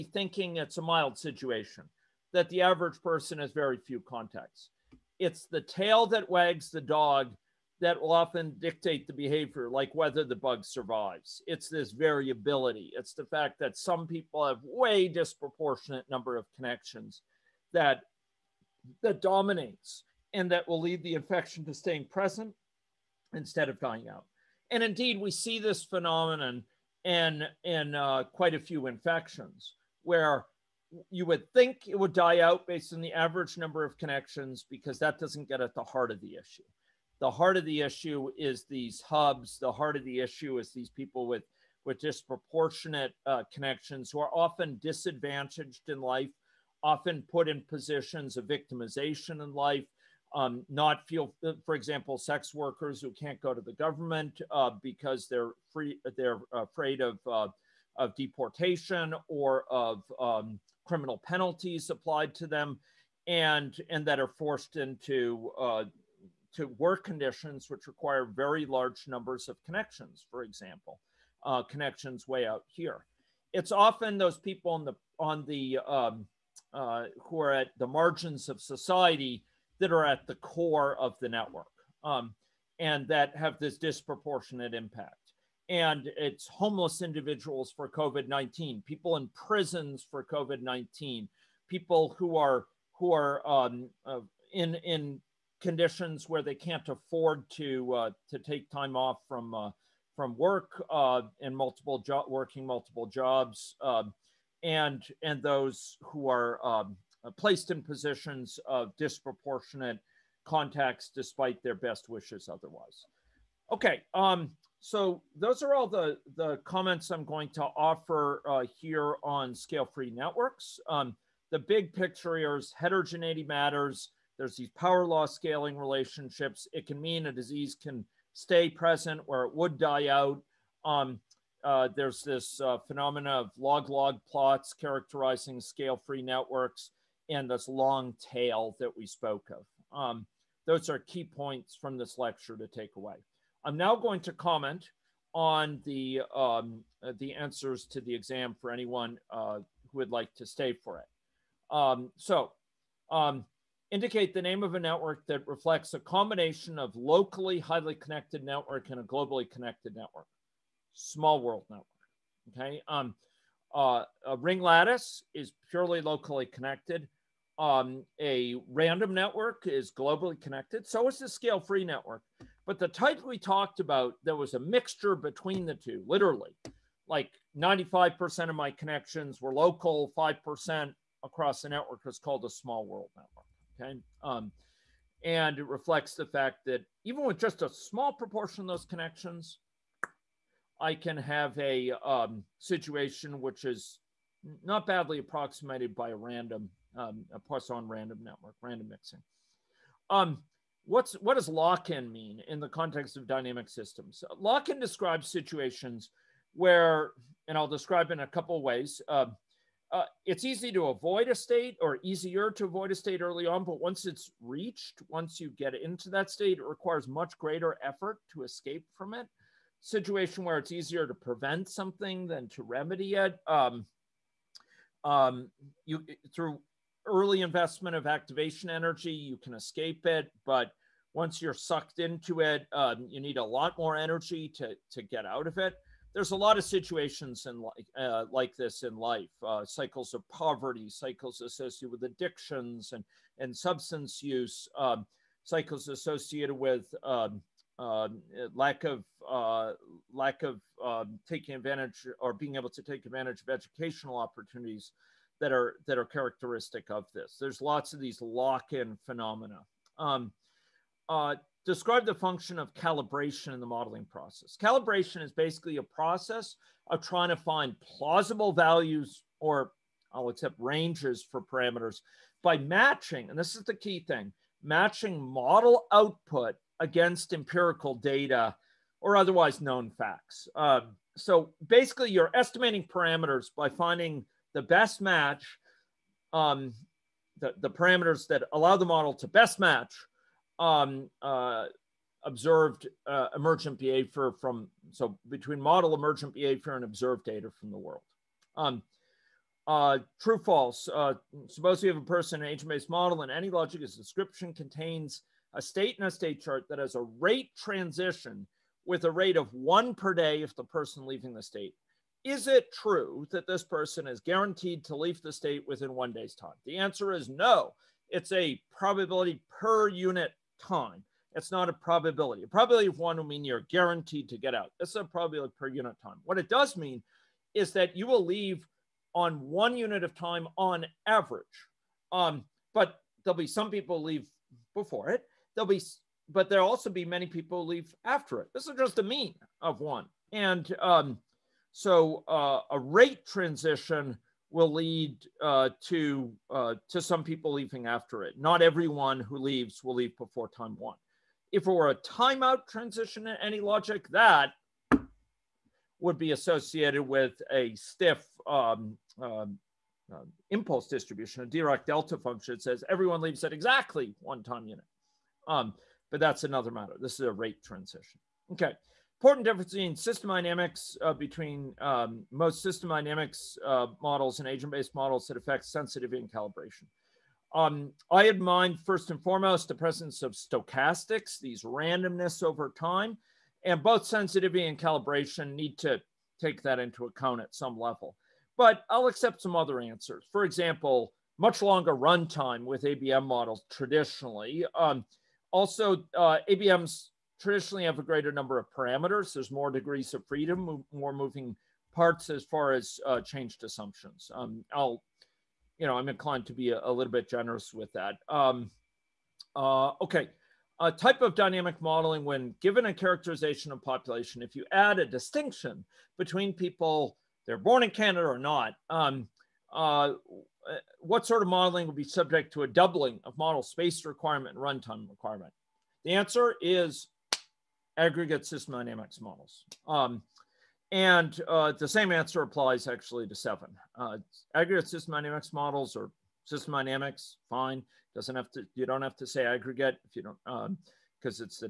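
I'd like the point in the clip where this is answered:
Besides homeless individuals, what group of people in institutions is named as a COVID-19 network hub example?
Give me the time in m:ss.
1:28.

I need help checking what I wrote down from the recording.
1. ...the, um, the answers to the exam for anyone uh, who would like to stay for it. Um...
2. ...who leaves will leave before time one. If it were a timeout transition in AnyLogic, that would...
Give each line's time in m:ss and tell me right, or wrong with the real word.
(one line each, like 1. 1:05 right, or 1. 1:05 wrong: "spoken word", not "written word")
1. 2:25 right
2. 5:49 right.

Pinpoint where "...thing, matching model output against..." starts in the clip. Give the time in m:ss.
4:34.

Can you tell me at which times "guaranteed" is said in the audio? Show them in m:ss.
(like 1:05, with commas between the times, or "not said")
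5:14, 5:23.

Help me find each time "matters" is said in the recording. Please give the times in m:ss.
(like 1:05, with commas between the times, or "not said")
2:03, 6:06.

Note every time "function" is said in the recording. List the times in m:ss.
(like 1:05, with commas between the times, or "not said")
4:22, 6:02.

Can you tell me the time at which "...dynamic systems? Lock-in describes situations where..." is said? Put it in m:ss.
3:23.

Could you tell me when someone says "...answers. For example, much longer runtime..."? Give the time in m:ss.
6:29.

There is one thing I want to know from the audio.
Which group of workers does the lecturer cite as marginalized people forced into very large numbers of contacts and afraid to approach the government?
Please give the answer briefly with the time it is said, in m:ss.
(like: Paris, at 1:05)
Sex workers, at 0:52.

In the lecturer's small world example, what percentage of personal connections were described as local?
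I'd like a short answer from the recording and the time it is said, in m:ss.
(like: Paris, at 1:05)
95%, at 2:57.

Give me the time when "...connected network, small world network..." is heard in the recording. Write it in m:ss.
2:39.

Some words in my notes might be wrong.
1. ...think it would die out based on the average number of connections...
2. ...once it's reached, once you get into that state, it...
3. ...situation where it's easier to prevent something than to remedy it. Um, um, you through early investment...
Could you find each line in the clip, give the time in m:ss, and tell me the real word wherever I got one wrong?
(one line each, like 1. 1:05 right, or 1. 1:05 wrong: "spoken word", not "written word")
1. 0:31 right
2. 3:33 right
3. 3:39 right.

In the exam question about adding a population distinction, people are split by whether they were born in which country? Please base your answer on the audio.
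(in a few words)
Canada.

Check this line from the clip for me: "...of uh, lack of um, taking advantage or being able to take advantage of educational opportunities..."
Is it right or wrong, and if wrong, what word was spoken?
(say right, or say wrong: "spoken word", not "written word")
right.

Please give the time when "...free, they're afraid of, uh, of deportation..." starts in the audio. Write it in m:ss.
0:55.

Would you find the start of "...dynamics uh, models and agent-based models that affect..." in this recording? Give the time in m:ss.
6:12.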